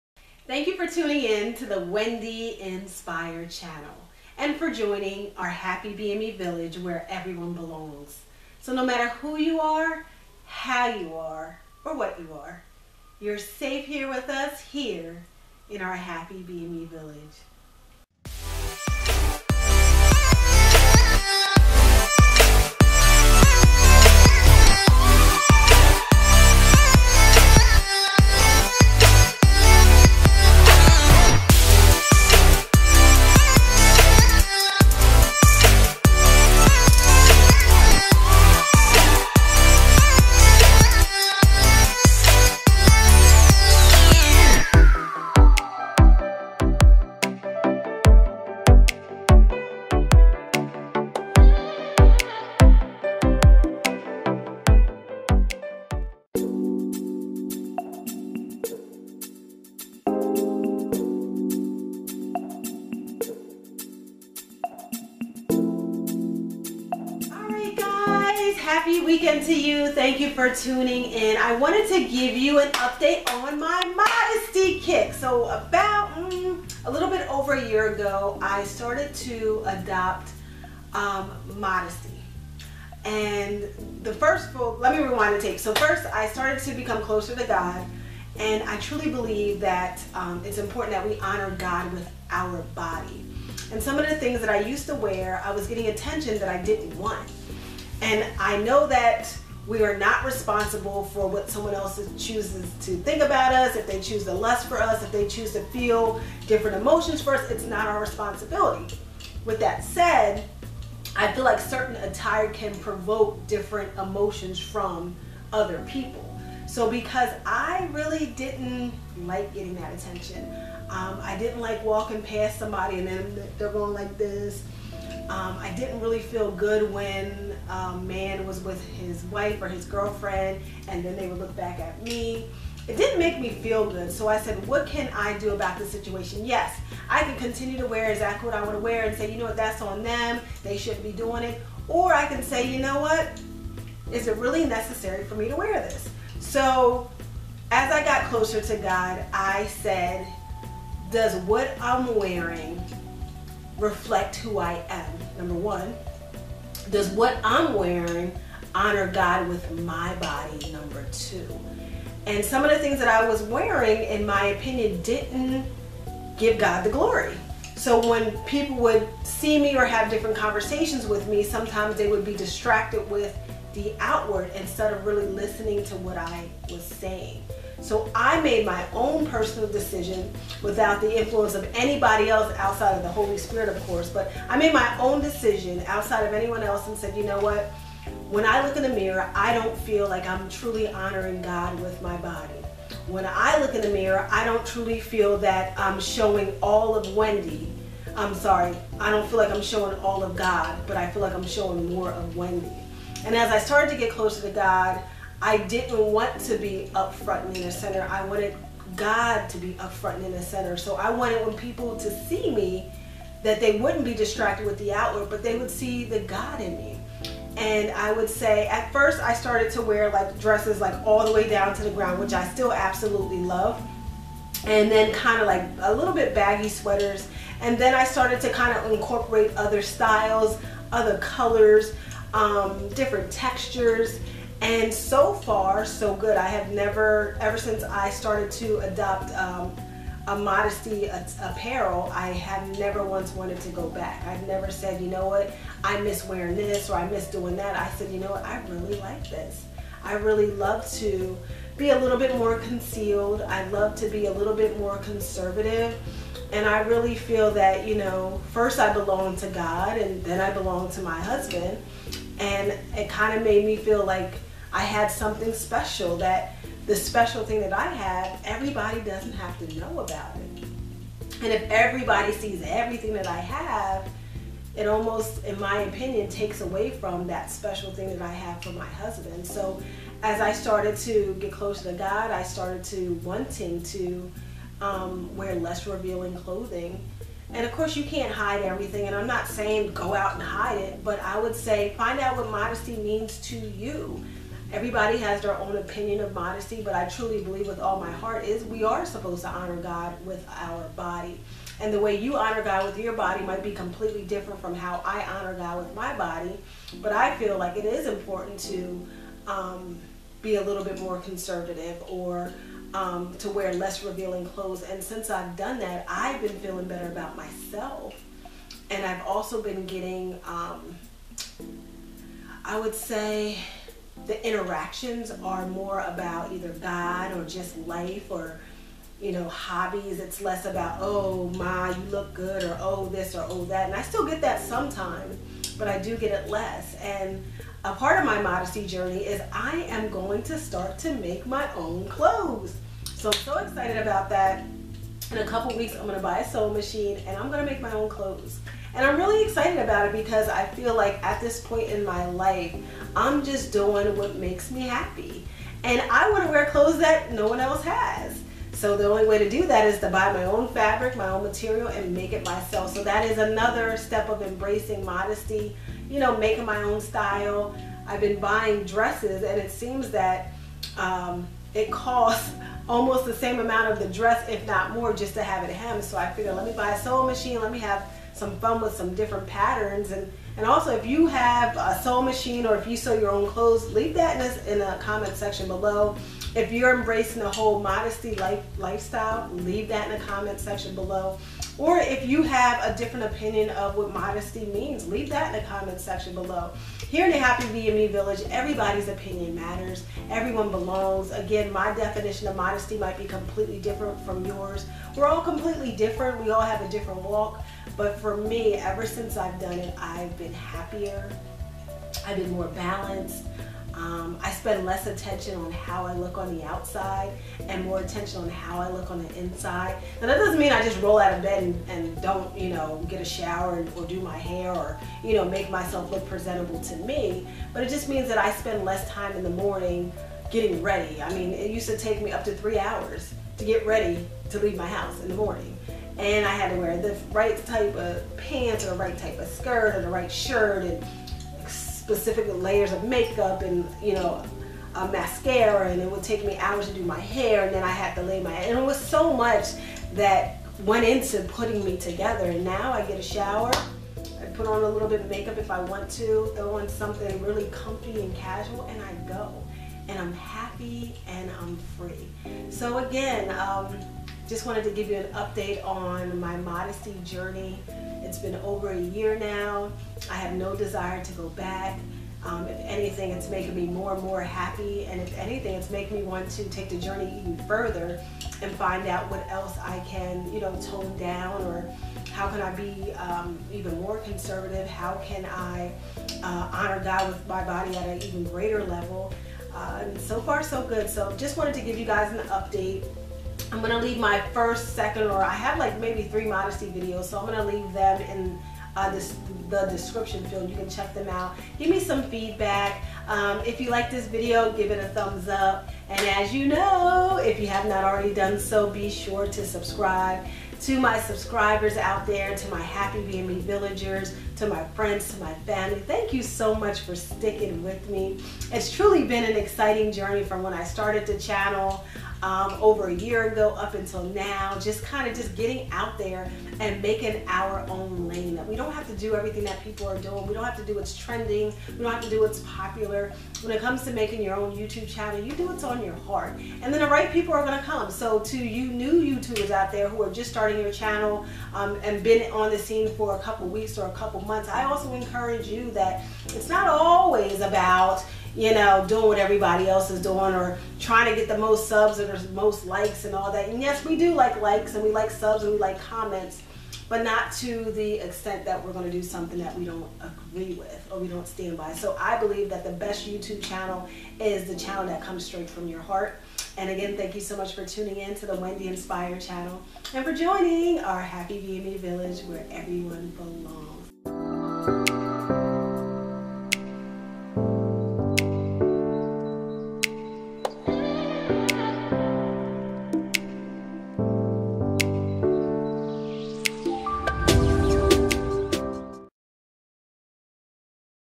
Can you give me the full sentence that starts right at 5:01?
And the way you honor God with your body might be completely different from how I honor God with my body.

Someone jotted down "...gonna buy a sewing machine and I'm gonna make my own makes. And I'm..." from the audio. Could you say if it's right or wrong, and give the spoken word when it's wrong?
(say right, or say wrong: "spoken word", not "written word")
wrong: "clothes", not "makes".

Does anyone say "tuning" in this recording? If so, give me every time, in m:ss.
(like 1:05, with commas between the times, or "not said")
0:00, 1:10, 9:27.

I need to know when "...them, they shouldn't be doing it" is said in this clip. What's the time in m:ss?
2:20.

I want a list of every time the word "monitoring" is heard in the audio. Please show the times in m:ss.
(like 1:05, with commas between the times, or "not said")
not said.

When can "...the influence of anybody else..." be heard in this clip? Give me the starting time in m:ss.
3:01.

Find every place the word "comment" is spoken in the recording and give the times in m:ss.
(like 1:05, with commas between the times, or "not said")
6:25, 6:30, 6:35, 9:16.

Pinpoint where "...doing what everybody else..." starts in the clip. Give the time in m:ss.
9:09.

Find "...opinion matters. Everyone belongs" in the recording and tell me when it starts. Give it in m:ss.
6:39.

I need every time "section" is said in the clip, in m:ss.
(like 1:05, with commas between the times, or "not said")
6:25, 6:30, 6:36.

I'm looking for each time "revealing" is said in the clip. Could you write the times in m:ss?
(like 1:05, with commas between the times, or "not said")
4:45, 5:14.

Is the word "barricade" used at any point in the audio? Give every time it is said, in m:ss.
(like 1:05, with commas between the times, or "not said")
not said.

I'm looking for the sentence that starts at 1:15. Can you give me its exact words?
So about mm, a little bit over a year ago, I started to adopt um, modesty.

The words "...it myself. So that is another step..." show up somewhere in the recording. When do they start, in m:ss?
6:02.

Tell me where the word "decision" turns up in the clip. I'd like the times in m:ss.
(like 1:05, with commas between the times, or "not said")
2:59, 3:05.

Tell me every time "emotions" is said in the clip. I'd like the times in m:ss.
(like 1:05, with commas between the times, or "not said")
1:46, 1:53.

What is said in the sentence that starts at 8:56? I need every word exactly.
And then the right people are going to come.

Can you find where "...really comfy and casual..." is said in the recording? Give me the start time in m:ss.
7:37.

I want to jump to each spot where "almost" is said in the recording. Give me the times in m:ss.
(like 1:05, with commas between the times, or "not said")
4:34, 6:12.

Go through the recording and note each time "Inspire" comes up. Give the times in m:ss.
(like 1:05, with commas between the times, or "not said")
0:02, 9:28.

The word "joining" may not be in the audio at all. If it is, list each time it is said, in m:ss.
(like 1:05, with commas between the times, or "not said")
0:04, 9:30.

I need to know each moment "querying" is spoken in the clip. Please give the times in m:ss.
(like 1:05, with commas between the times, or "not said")
not said.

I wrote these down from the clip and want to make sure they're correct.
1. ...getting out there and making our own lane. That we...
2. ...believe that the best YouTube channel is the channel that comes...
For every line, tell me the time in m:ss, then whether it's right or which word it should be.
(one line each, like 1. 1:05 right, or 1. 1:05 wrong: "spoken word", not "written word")
1. 8:45 right
2. 9:22 right.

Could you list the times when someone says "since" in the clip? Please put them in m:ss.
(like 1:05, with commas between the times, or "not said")
3:57, 5:15, 6:49.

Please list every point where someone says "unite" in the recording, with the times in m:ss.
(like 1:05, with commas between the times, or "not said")
not said.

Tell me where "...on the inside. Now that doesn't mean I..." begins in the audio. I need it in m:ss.
6:59.